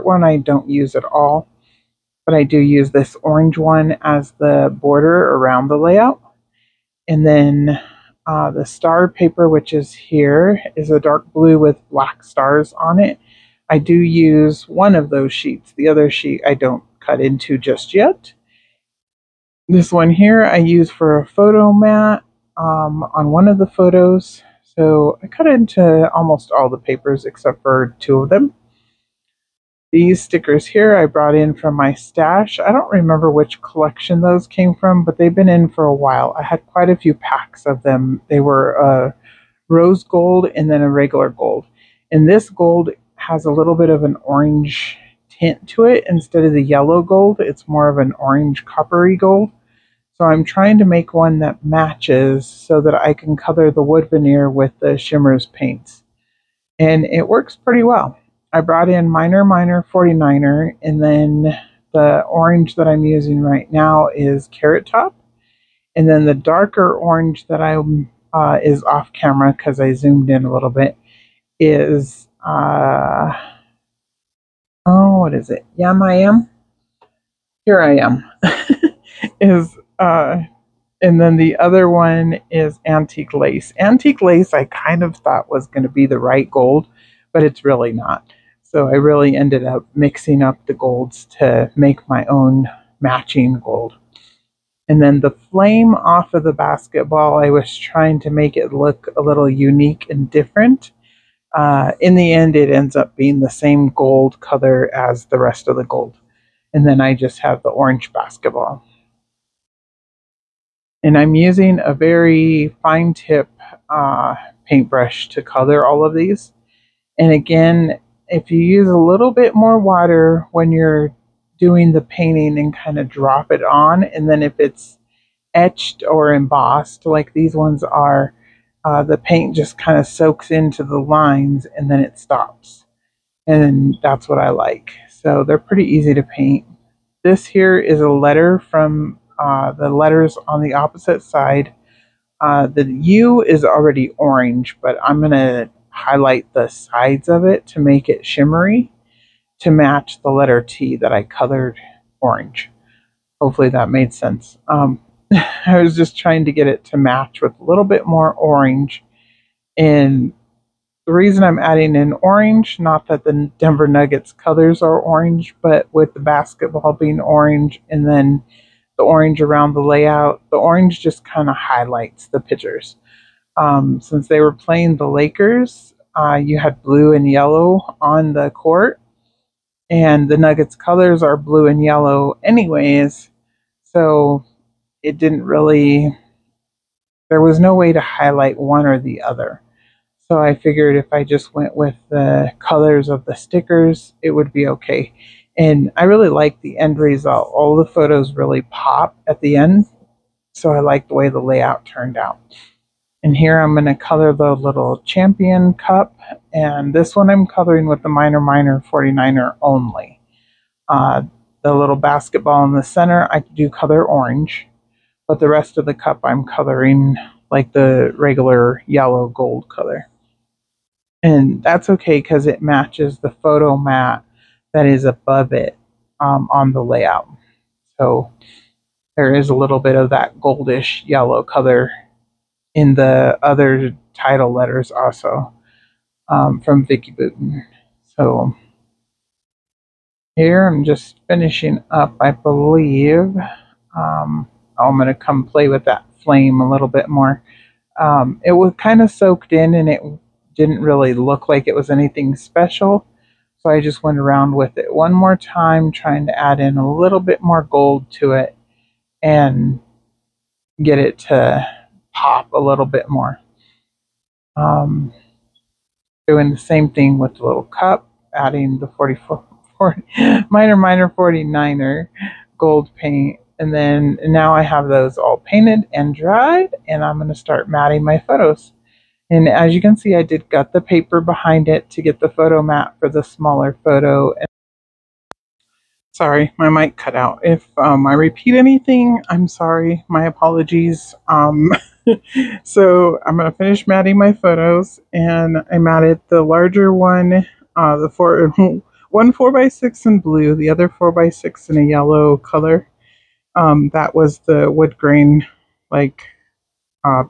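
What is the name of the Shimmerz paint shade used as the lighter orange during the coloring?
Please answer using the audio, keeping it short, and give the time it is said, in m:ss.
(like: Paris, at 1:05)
Carrot Top, at 1:04.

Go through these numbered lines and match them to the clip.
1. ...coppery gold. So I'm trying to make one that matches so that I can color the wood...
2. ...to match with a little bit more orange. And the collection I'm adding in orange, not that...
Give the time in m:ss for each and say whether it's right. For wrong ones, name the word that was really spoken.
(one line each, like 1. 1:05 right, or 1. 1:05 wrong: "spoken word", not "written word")
1. 0:48 right
2. 2:36 wrong: "reason", not "collection".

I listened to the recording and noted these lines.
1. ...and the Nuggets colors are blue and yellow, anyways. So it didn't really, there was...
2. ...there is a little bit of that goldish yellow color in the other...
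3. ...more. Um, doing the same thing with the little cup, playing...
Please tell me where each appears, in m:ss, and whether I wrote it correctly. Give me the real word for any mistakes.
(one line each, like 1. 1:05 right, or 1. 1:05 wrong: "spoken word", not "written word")
1. 2:59 right
2. 3:49 right
3. 4:23 wrong: "adding", not "playing".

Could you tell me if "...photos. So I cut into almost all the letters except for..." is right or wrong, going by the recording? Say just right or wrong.
wrong.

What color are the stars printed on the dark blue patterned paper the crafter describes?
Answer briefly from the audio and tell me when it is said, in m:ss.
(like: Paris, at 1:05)
Black, at 0:11.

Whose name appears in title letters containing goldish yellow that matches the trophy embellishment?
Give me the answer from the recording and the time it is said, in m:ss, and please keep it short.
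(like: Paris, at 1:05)
Vicki Boutin, at 3:56.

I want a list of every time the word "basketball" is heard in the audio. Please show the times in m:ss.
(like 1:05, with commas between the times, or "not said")
1:36, 1:48, 2:46, 3:31.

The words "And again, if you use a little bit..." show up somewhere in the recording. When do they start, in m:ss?
1:57.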